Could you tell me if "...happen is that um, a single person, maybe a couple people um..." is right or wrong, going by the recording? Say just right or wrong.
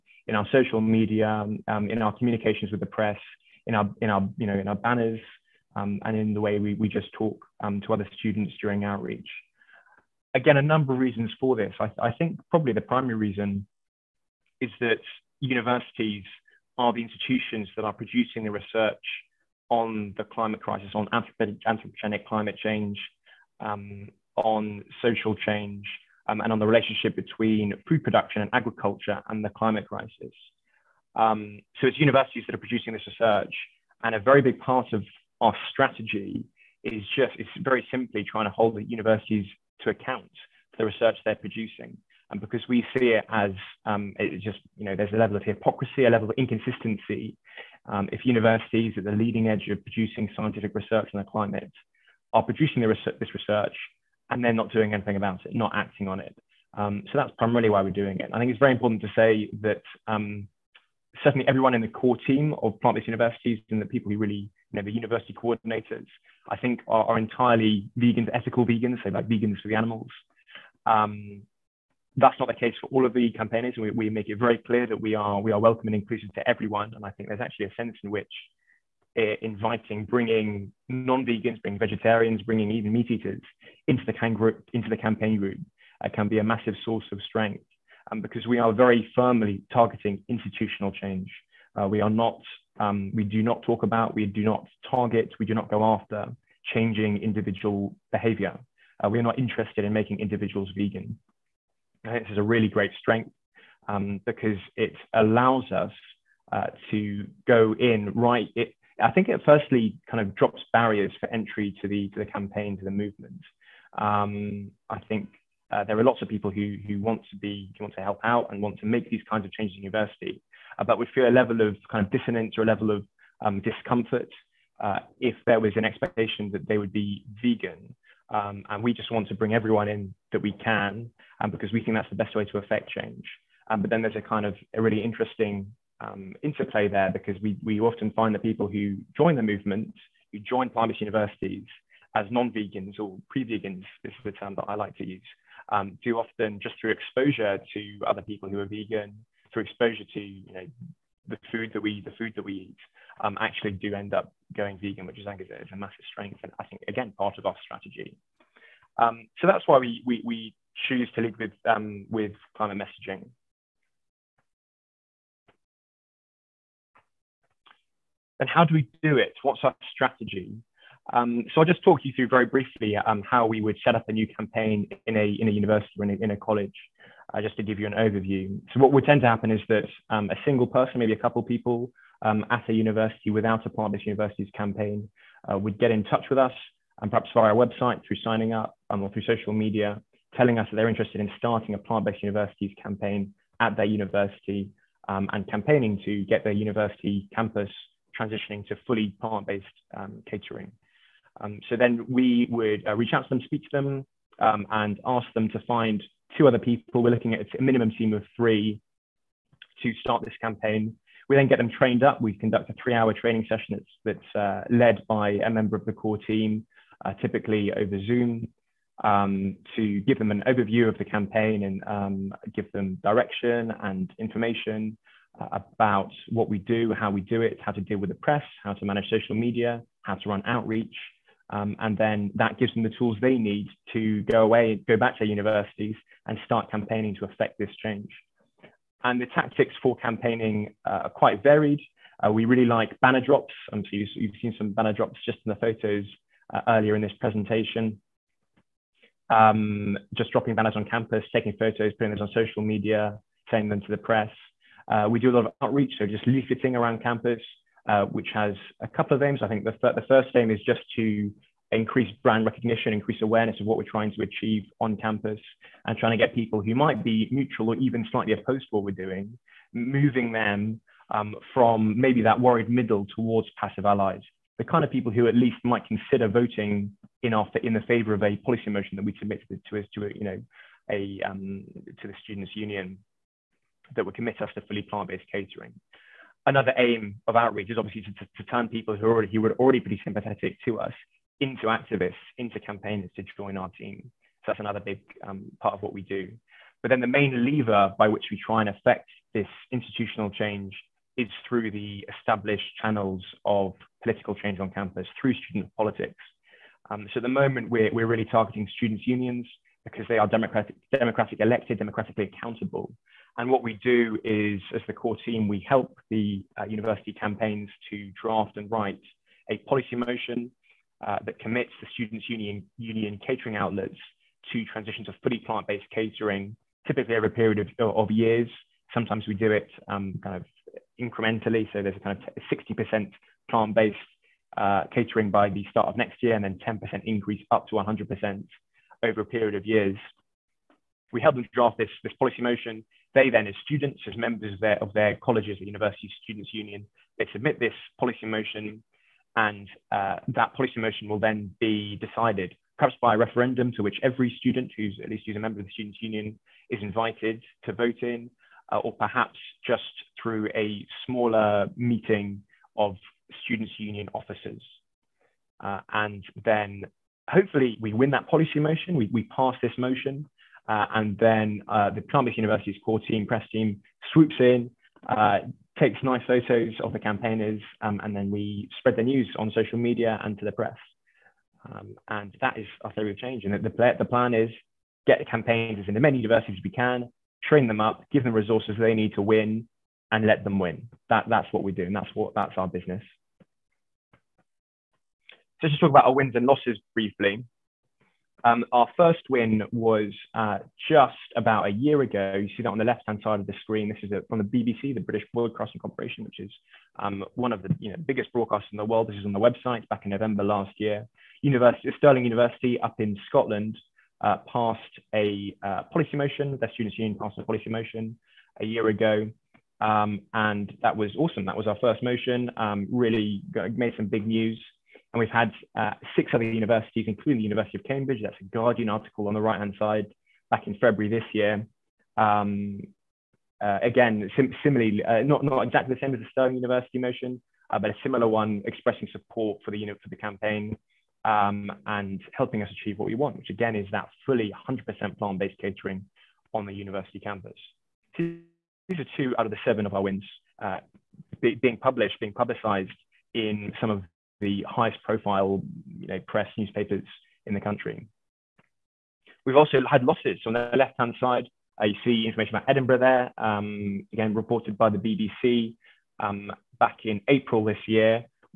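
right.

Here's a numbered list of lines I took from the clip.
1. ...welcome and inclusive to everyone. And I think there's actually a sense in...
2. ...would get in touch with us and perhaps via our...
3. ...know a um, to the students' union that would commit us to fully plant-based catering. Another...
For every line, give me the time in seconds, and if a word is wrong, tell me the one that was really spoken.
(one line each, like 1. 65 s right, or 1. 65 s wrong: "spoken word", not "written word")
1. 75 s right
2. 185 s right
3. 280 s right.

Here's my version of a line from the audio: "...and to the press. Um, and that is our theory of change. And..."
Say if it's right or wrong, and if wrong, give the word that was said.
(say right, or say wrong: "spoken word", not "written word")
right.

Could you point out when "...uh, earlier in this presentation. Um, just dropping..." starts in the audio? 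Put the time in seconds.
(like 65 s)
246 s.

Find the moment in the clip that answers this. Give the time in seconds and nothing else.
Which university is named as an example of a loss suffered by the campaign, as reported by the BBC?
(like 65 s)
462 s.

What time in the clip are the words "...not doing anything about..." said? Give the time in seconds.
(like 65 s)
54 s.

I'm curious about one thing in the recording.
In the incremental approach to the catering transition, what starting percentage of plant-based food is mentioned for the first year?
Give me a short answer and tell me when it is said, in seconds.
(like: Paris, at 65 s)
60%, at 332 s.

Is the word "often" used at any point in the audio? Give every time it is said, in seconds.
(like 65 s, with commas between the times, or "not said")
137 s, 146 s.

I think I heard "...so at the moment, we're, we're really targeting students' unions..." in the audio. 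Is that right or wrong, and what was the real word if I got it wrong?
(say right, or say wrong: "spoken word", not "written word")
right.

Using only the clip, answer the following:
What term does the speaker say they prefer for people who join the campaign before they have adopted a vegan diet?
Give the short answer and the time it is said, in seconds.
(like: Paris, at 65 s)
pre vegans, at 143 s.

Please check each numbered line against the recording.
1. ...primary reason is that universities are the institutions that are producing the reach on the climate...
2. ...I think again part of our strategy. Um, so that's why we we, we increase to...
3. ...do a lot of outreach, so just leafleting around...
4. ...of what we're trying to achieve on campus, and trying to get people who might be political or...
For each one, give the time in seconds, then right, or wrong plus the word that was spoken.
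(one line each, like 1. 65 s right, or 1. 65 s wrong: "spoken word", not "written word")
1. 12 s wrong: "research", not "reach"
2. 156 s wrong: "choose", not "increase"
3. 255 s right
4. 263 s wrong: "neutral", not "political".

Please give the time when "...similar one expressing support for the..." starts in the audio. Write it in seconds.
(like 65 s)
438 s.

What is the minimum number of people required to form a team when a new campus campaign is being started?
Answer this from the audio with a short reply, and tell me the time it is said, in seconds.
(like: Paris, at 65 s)
3, at 208 s.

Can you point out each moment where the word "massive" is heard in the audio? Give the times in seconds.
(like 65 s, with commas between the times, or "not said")
86 s, 155 s.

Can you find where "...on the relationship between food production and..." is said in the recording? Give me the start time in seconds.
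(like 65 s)
26 s.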